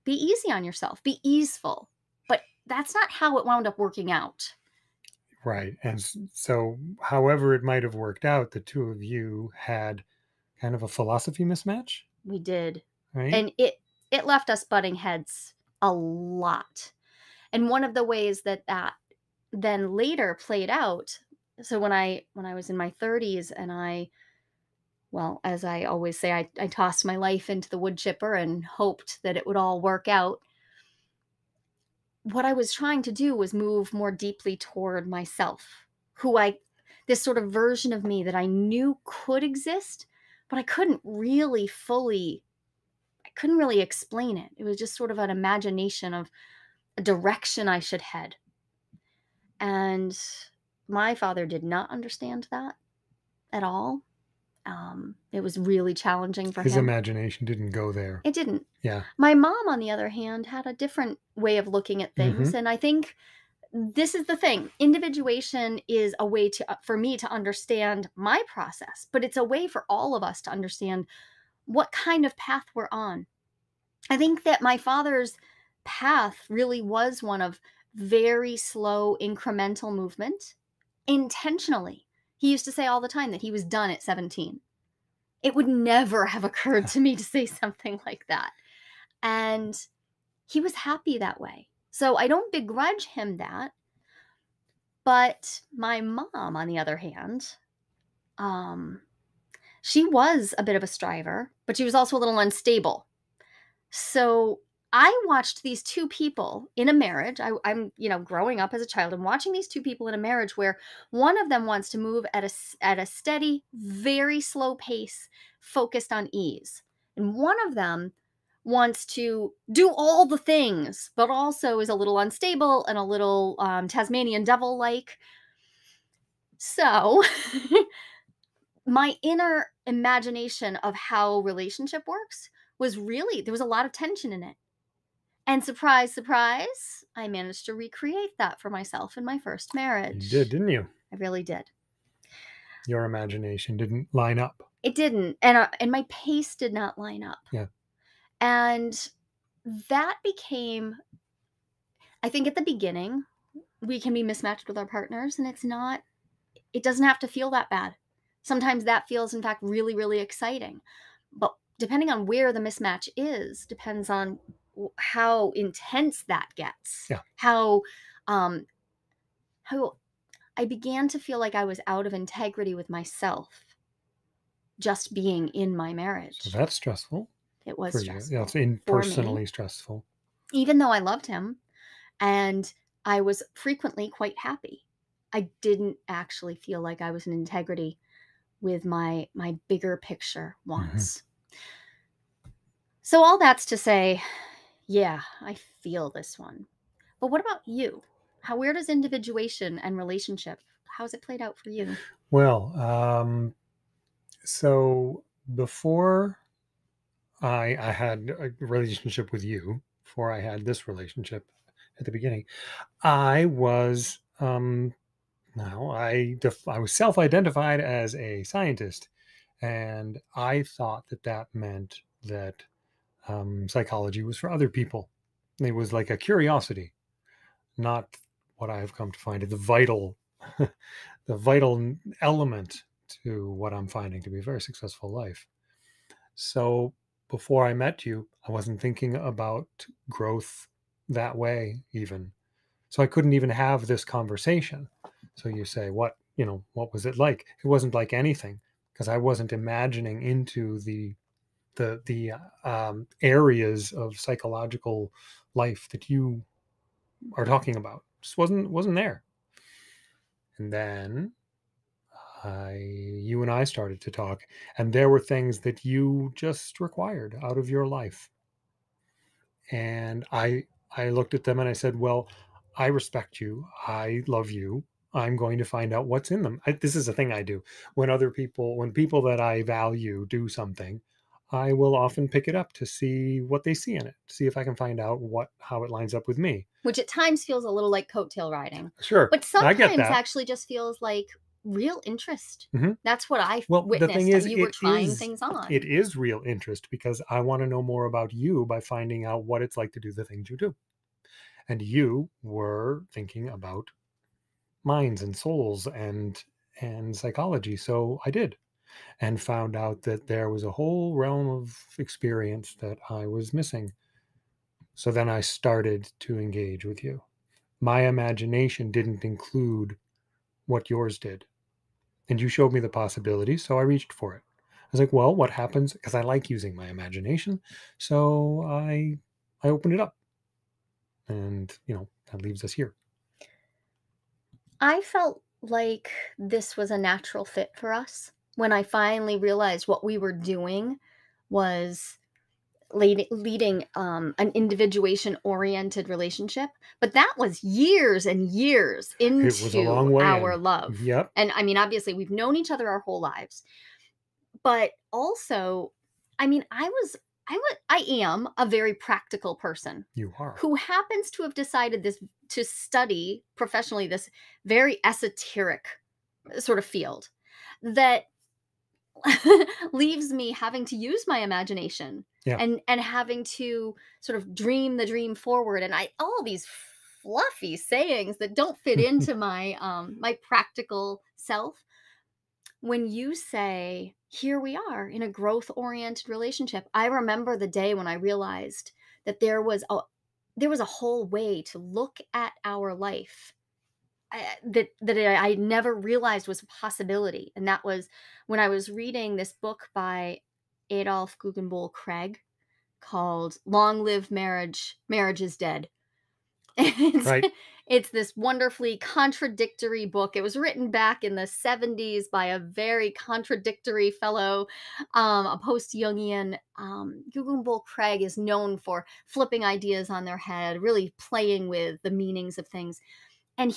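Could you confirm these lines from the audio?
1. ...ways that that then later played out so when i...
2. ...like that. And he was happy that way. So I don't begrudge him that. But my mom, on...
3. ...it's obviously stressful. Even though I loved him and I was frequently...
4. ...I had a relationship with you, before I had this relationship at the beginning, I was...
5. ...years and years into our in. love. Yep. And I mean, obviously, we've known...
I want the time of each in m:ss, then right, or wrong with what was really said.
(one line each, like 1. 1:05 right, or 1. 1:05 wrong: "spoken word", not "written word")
1. 0:18 right
2. 1:28 right
3. 2:58 wrong: "personally", not "obviously"
4. 3:27 right
5. 5:47 right.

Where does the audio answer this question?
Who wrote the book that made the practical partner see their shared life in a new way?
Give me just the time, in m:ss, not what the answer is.
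6:40.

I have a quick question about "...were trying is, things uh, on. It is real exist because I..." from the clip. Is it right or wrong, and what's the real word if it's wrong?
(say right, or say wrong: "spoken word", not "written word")
wrong: "interest", not "exist".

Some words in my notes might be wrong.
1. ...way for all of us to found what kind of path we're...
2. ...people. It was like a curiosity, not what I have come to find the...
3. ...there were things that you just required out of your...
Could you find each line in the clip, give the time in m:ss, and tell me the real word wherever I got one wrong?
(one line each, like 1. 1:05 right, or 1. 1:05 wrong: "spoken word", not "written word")
1. 1:09 wrong: "understand", not "found"
2. 3:44 right
3. 4:24 right.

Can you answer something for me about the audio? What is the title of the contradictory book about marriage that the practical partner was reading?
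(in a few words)
Long Live Marriage: Marriage is Dead.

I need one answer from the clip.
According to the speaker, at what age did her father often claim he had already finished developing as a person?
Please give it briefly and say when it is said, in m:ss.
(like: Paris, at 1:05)
17, at 1:24.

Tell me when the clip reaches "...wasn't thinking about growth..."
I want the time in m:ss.
3:58.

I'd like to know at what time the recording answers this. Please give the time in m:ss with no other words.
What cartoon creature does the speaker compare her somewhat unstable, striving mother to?
2:03.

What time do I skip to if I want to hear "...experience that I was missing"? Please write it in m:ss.
5:11.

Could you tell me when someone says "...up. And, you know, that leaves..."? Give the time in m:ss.
5:30.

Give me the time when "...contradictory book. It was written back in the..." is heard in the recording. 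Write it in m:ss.
6:48.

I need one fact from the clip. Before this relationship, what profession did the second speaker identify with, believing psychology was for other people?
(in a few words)
Scientist.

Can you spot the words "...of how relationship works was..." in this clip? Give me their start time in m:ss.
2:10.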